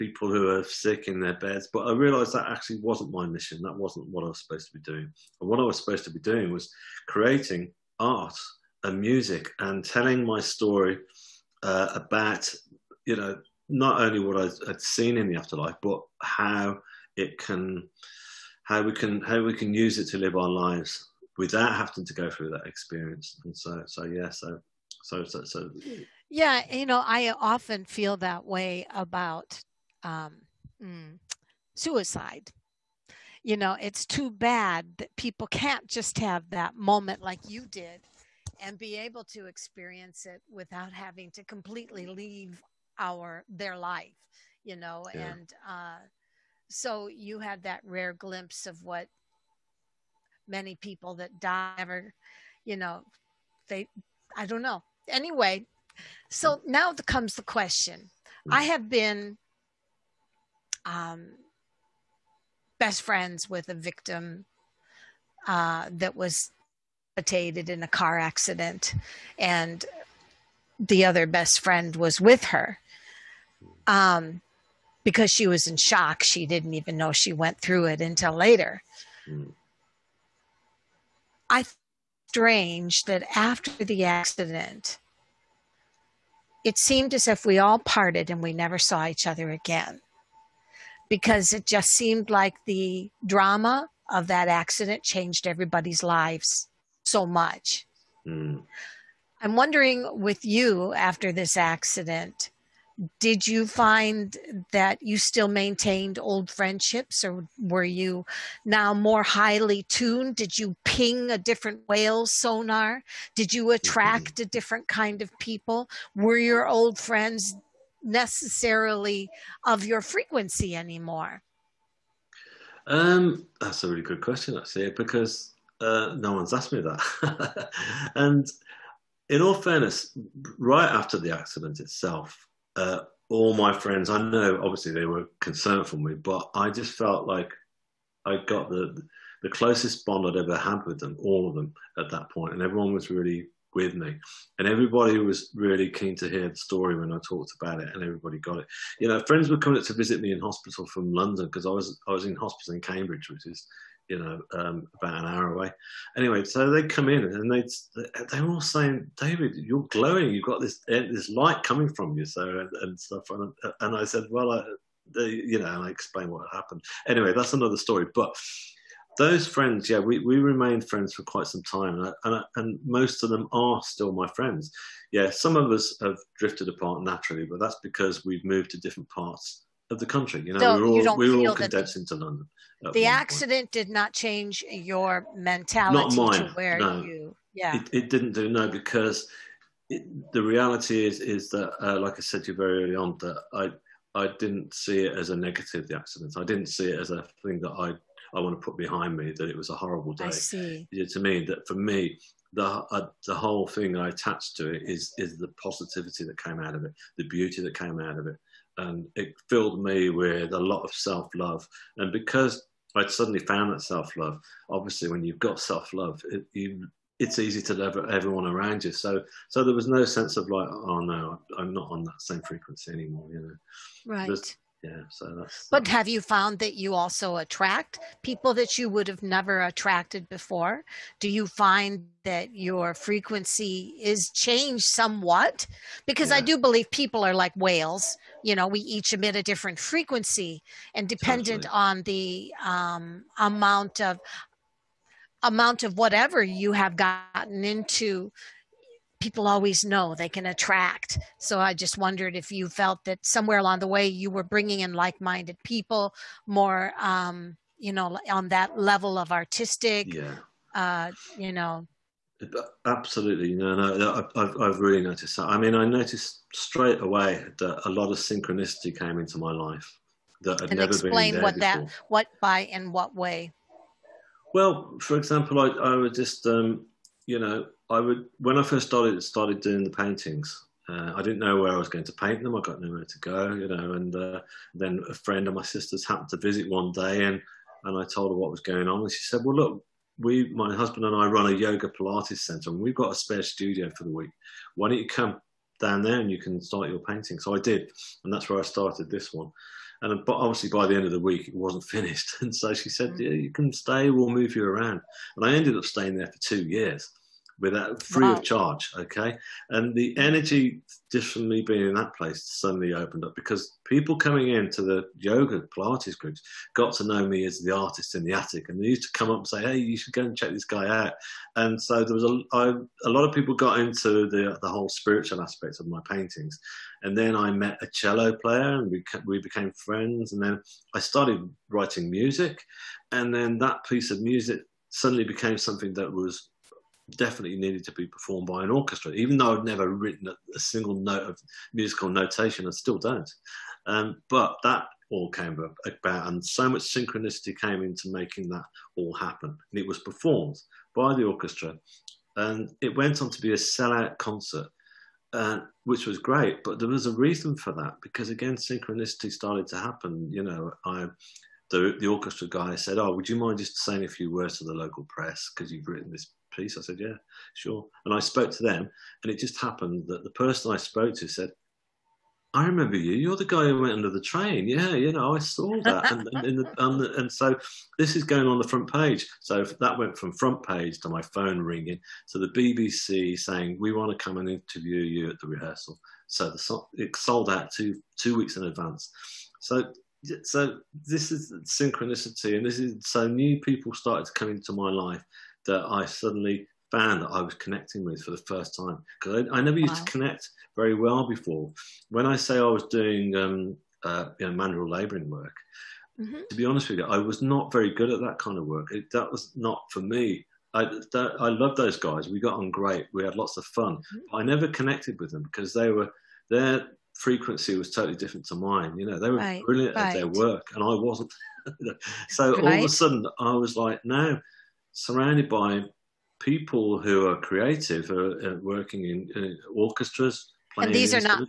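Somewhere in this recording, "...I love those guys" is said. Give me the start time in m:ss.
6:51.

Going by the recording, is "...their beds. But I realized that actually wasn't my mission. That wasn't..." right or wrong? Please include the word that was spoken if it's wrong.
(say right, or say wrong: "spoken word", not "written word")
right.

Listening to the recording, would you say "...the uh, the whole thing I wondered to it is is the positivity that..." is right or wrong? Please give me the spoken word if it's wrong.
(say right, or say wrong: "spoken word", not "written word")
wrong: "attached", not "wondered".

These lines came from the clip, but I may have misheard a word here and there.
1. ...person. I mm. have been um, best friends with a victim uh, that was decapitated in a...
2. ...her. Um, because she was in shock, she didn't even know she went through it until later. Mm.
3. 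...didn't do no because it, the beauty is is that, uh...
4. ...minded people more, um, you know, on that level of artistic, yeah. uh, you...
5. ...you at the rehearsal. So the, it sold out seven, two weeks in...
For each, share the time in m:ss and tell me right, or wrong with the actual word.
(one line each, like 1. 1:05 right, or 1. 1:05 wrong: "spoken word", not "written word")
1. 0:57 wrong: "question", not "person"
2. 1:12 right
3. 3:08 wrong: "reality", not "beauty"
4. 4:15 right
5. 6:25 wrong: "two", not "seven".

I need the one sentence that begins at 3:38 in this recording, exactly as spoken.
So, so there was no sense of like, oh no, I'm not on that same frequency anymore.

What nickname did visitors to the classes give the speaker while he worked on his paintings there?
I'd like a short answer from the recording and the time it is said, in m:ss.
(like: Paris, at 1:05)
The artist in the attic, at 5:17.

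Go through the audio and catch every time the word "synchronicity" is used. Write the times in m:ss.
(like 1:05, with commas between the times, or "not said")
4:28, 5:46, 5:58, 6:31.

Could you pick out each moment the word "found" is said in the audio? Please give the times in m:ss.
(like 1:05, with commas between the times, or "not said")
3:33, 3:46, 6:36.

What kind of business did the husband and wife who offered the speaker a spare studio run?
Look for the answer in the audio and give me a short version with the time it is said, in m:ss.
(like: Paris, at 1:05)
Yoga Pilates center, at 4:51.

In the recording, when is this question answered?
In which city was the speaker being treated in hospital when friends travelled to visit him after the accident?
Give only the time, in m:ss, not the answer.
2:32.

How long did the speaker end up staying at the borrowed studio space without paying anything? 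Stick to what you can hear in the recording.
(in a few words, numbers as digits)
2 years.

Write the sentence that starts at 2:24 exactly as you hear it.
And everybody was really keen to hear the story when I talked about it, and everybody got it.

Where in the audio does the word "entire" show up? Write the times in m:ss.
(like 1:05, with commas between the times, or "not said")
not said.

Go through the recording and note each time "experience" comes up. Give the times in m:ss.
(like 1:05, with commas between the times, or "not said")
0:22, 0:39.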